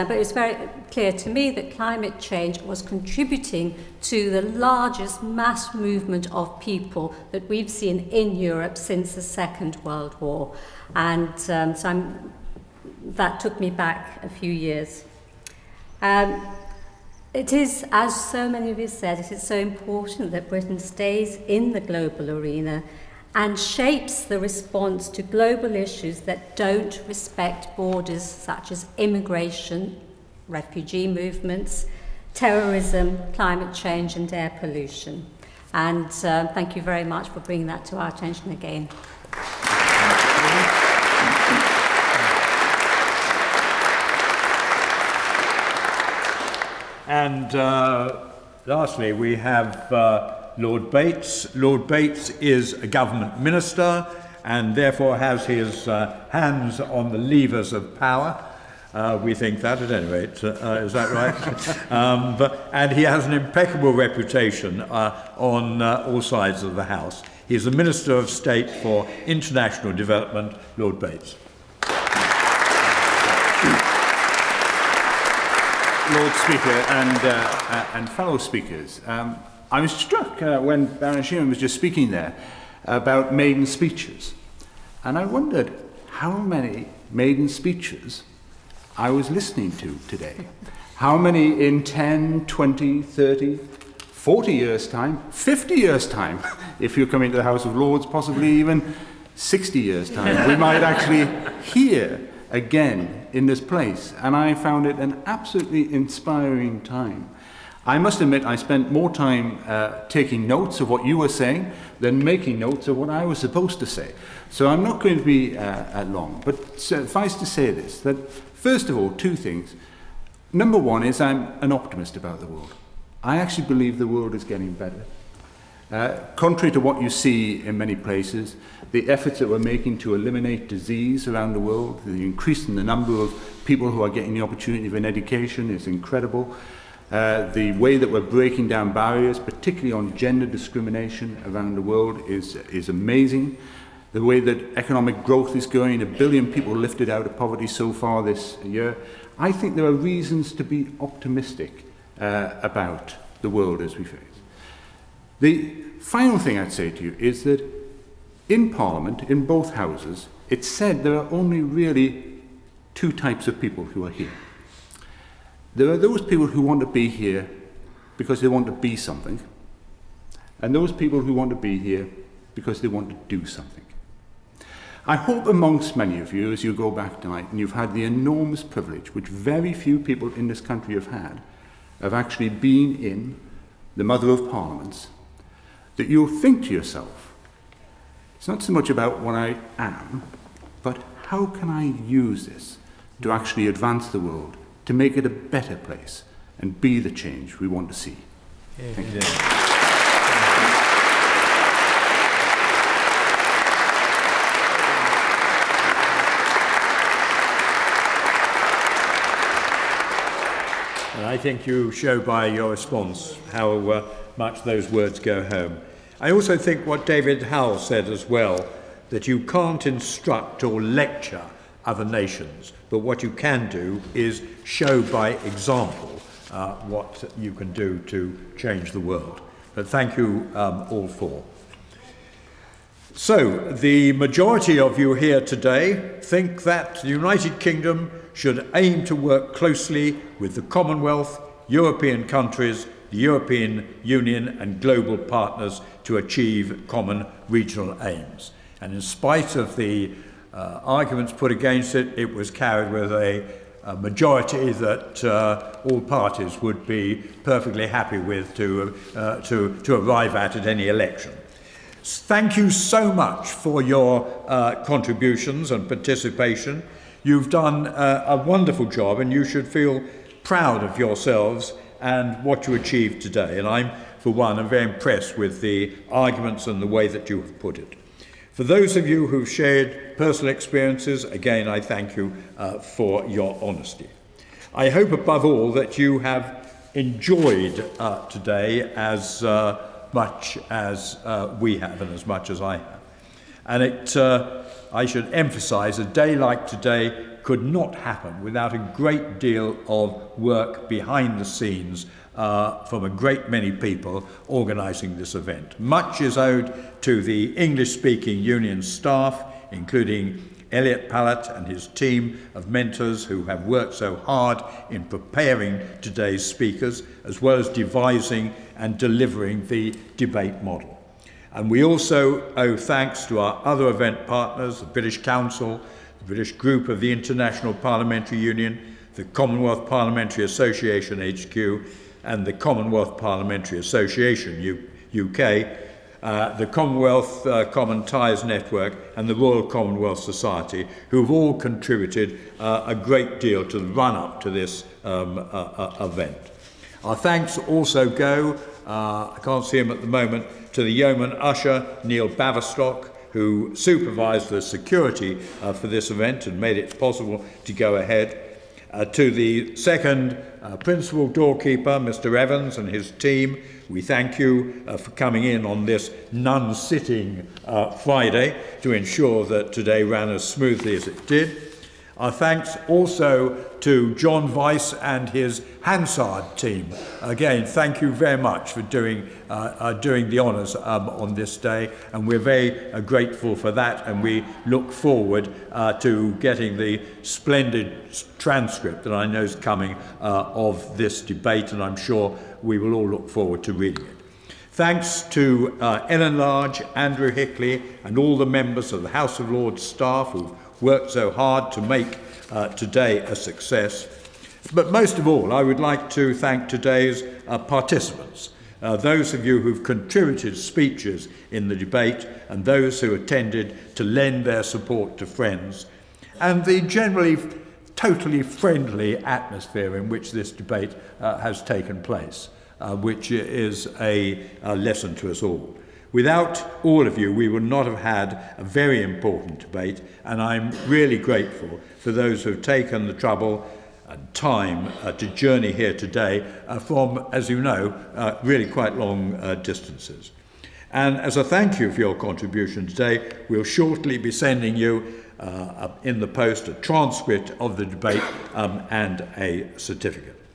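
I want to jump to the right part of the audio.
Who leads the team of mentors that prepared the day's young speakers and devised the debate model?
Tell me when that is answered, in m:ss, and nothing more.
5:10.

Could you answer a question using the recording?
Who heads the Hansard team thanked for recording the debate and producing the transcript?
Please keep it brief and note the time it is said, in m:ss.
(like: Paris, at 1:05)
John Vice, at 6:14.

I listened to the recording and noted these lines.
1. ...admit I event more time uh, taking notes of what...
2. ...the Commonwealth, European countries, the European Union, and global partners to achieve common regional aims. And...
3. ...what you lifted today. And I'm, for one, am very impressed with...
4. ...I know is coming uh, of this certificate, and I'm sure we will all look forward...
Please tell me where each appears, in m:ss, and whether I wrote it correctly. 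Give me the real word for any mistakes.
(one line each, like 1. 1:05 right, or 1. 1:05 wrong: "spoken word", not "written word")
1. 1:48 wrong: "spent", not "event"
2. 4:00 right
3. 4:32 wrong: "achieved", not "lifted"
4. 6:29 wrong: "debate", not "certificate".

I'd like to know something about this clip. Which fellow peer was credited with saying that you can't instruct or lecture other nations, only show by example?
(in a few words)
David Howell.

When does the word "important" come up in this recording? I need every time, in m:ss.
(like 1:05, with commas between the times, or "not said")
0:19, 7:09.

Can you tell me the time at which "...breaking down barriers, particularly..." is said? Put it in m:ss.
2:18.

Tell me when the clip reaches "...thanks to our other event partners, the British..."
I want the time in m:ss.
5:22.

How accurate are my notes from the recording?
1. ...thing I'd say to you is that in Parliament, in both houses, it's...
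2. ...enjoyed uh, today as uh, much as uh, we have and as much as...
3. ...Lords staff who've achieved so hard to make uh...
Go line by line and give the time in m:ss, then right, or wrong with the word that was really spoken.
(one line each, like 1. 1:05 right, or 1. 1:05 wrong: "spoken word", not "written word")
1. 2:36 right
2. 4:46 right
3. 6:39 wrong: "worked", not "achieved".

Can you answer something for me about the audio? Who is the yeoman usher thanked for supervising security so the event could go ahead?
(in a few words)
Neil Baverstock.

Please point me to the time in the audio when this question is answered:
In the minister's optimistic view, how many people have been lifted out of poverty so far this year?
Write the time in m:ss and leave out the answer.
2:26.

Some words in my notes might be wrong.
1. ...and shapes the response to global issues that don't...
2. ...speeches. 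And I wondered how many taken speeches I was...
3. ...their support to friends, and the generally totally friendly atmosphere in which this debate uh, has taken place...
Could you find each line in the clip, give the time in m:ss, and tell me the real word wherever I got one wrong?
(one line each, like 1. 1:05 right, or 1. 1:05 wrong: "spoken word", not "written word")
1. 0:23 right
2. 1:23 wrong: "maiden", not "taken"
3. 6:54 right.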